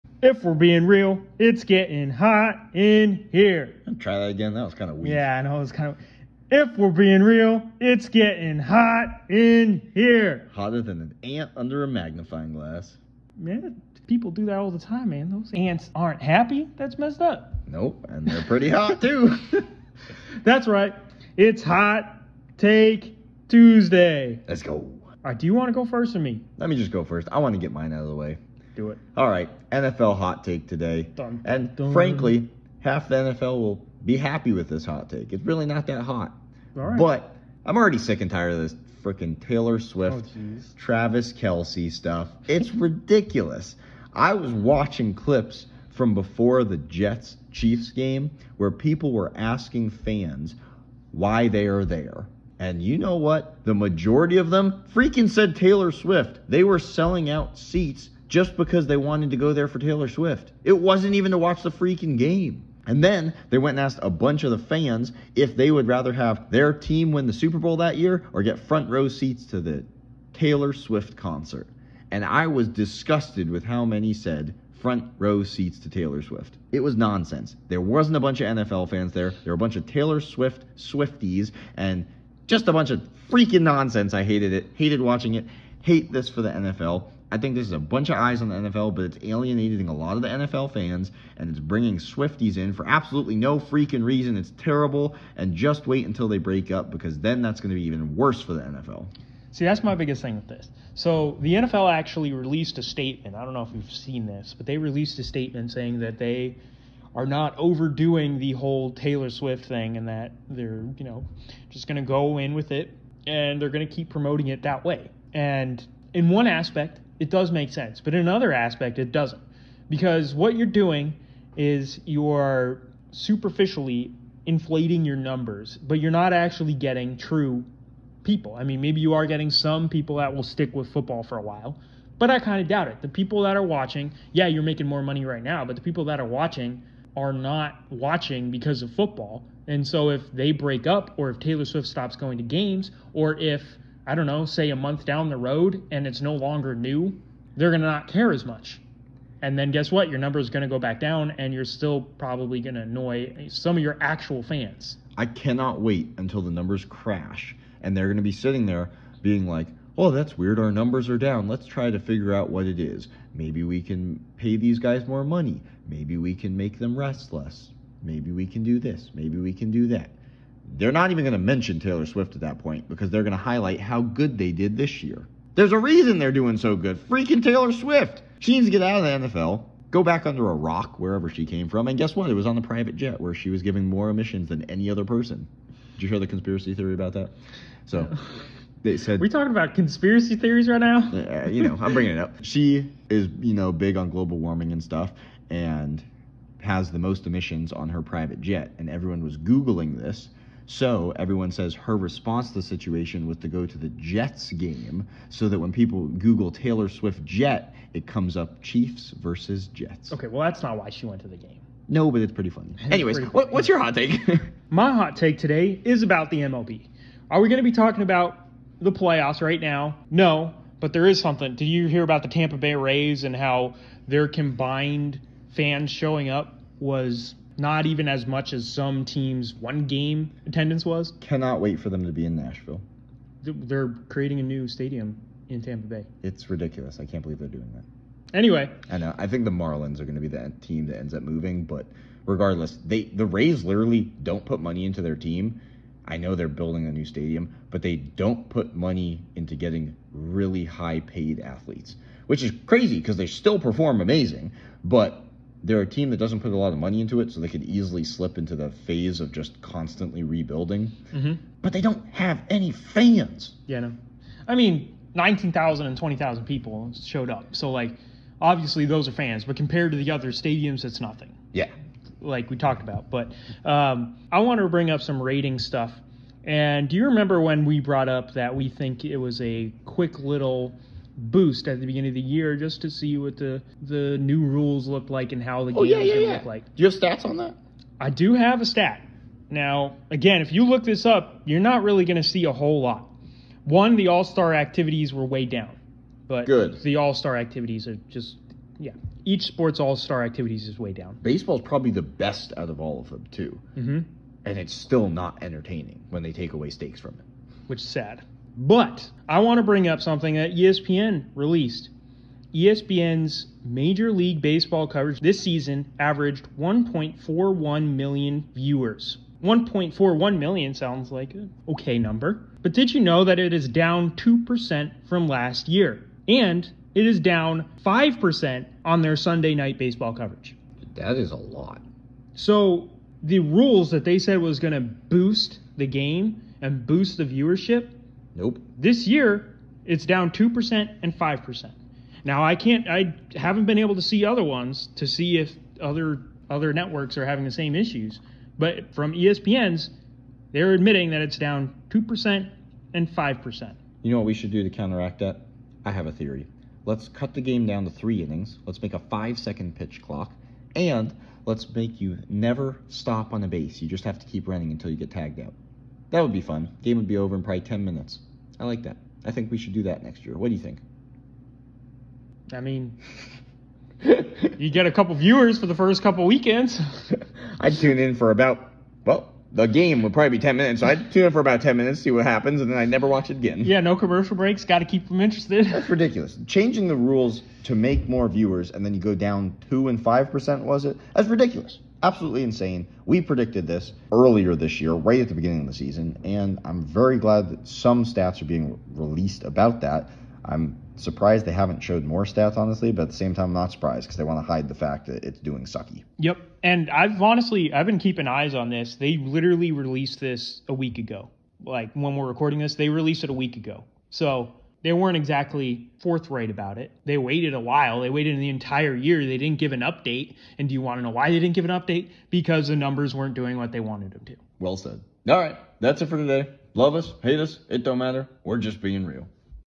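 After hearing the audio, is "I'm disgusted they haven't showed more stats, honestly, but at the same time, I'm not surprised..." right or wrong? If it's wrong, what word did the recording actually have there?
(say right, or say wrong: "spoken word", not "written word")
wrong: "surprised", not "disgusted".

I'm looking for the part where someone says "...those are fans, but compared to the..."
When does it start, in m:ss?
4:28.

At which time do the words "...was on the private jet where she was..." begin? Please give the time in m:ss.
3:02.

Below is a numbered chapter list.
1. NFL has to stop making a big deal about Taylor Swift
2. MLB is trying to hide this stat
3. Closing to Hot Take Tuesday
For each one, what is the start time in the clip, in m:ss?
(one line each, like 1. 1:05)
1. 0:32
2. 3:35
3. 6:25.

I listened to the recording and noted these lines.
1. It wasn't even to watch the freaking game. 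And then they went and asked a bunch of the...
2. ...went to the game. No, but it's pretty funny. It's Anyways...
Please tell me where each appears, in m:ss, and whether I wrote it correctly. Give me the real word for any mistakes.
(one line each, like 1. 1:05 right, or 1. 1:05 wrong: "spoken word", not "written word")
1. 1:00 right
2. 3:31 right.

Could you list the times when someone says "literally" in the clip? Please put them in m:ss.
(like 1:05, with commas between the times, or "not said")
4:03, 6:49.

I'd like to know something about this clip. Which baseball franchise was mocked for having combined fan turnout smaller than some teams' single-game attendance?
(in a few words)
Tampa Bay Rays.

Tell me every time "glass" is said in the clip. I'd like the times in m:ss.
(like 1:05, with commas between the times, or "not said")
0:12.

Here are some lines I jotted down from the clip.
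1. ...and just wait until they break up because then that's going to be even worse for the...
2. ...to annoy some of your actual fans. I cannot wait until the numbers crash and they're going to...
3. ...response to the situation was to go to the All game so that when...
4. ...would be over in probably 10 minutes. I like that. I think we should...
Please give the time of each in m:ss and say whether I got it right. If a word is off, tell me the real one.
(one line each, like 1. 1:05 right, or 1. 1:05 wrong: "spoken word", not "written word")
1. 1:35 right
2. 2:32 right
3. 3:21 wrong: "Jets", not "All"
4. 6:06 right.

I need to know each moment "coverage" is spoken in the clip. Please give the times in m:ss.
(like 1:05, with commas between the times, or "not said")
5:14, 5:30.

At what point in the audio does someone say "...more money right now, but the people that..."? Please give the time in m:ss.
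2:14.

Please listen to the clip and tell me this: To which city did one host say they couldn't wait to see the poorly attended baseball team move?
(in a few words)
Nashville.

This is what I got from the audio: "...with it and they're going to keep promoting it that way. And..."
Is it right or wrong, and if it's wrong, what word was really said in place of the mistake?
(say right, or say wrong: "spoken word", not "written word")
right.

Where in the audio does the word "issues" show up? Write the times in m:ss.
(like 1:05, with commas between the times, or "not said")
5:47.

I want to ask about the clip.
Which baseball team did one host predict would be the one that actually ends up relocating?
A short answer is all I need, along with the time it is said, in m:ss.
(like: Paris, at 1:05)
Marlins, at 3:59.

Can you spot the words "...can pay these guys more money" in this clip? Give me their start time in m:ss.
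2:43.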